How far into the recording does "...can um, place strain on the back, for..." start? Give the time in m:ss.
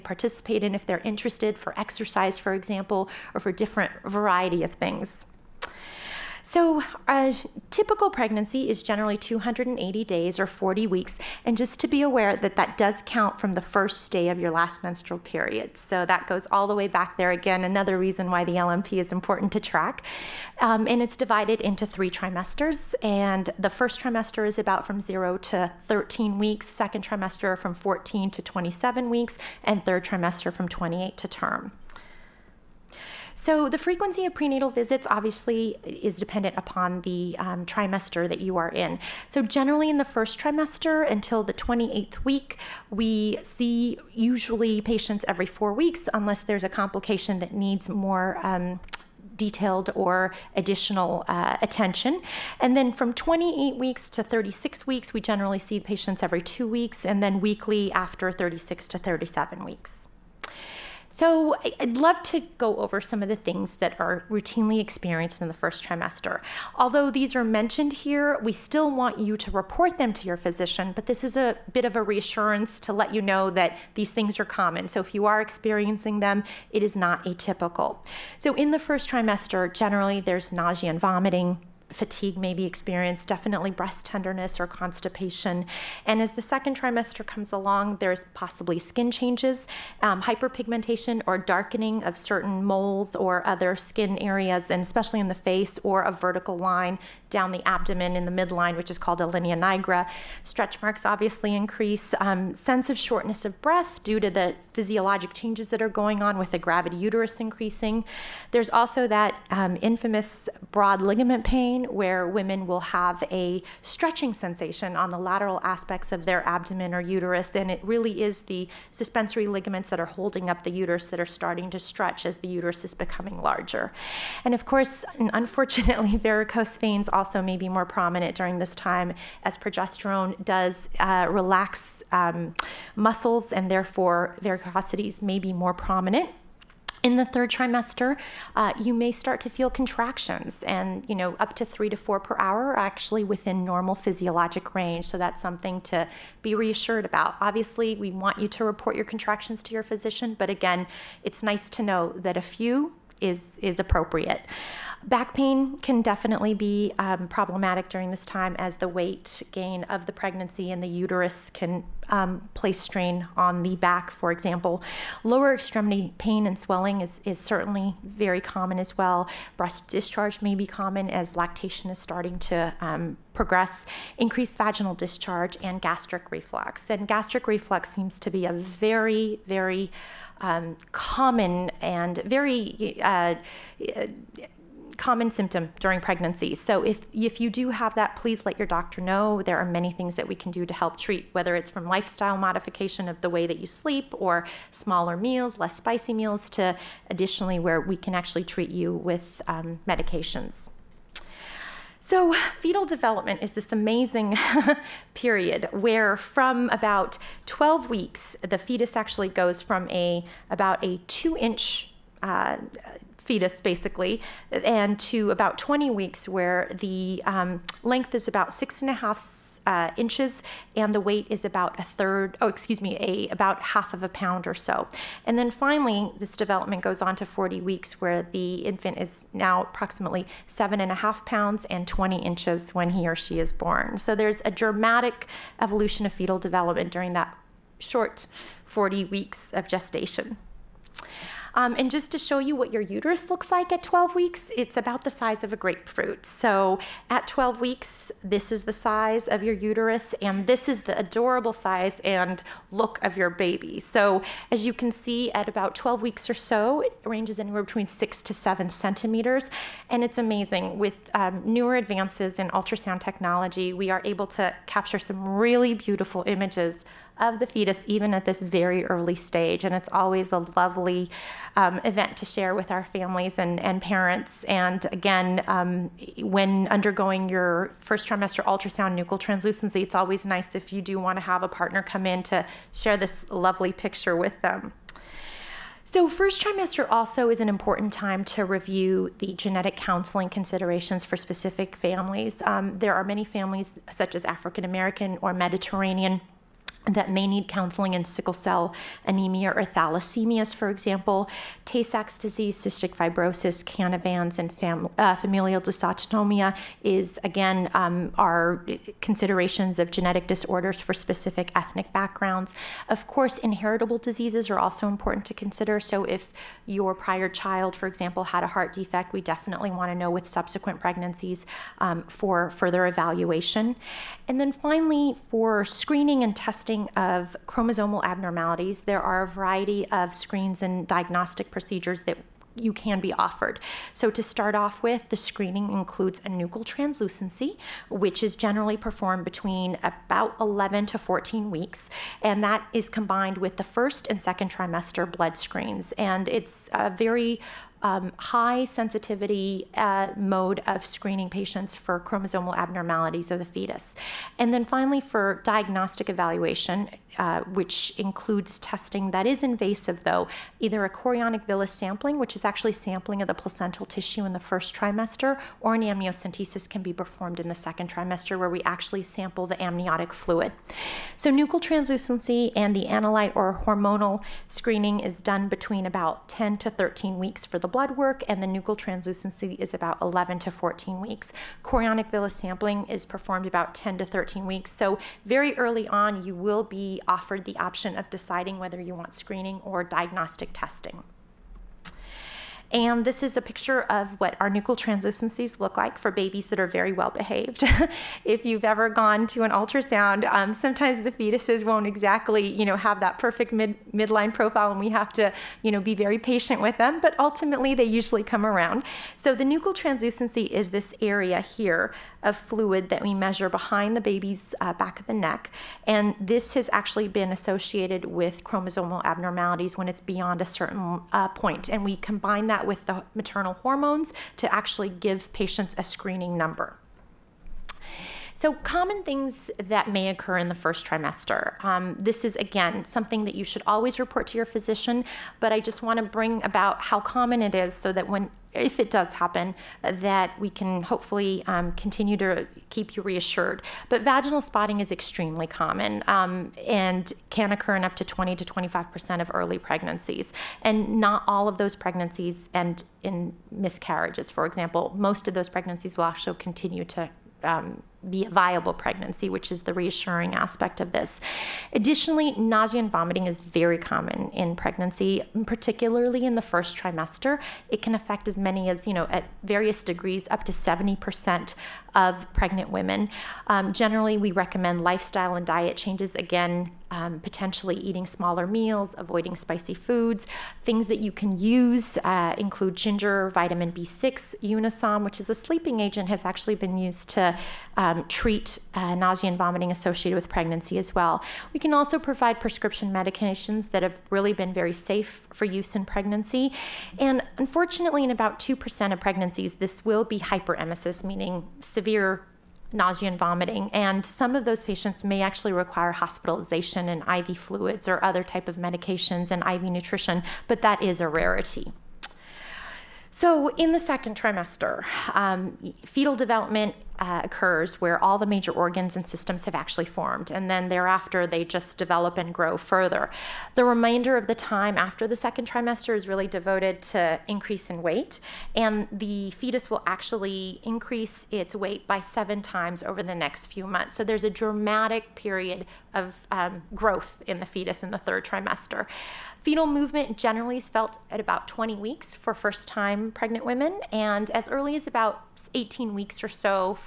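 2:41.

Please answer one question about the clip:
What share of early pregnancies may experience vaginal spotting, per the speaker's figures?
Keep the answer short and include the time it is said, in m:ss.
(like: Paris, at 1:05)
20 to 25%, at 7:28.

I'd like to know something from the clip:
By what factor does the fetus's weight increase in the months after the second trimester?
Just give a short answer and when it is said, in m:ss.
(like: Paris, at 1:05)
7 times, at 8:52.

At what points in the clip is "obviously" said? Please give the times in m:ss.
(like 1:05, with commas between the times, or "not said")
0:35, 1:41, 2:27.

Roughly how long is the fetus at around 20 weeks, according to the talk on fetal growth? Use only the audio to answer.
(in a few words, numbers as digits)
6.5 inches.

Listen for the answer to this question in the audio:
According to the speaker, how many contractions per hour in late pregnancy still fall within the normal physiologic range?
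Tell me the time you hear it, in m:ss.
2:21.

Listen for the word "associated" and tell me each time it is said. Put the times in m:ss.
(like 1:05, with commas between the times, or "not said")
6:57, 8:09.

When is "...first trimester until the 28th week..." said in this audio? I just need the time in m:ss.
0:40.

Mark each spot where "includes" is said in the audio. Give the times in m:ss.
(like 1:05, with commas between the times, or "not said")
5:35, 5:57, 8:02.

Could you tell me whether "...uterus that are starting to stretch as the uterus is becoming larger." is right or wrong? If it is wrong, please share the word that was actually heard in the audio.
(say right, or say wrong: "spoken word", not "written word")
right.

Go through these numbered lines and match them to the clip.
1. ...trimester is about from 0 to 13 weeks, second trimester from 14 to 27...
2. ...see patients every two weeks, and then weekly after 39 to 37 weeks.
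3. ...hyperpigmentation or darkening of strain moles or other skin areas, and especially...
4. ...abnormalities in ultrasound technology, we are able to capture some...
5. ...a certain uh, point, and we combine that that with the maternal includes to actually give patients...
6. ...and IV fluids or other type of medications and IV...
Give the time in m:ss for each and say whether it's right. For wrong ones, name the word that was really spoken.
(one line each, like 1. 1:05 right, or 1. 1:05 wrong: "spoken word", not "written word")
1. 0:23 right
2. 0:55 wrong: "36", not "39"
3. 1:30 wrong: "certain", not "strain"
4. 4:21 wrong: "advances", not "abnormalities"
5. 7:00 wrong: "hormones", not "includes"
6. 8:26 right.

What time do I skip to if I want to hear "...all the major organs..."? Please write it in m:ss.
8:38.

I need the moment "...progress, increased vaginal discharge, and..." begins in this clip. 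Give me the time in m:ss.
2:53.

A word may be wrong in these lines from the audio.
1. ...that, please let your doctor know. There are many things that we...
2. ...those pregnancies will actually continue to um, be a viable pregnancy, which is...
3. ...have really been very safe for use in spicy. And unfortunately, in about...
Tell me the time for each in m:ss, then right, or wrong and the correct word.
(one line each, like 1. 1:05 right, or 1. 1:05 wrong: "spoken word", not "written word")
1. 3:07 right
2. 7:35 right
3. 8:13 wrong: "pregnancy", not "spicy".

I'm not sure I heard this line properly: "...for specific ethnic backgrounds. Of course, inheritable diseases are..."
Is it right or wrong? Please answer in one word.
right.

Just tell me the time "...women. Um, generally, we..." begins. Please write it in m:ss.
7:52.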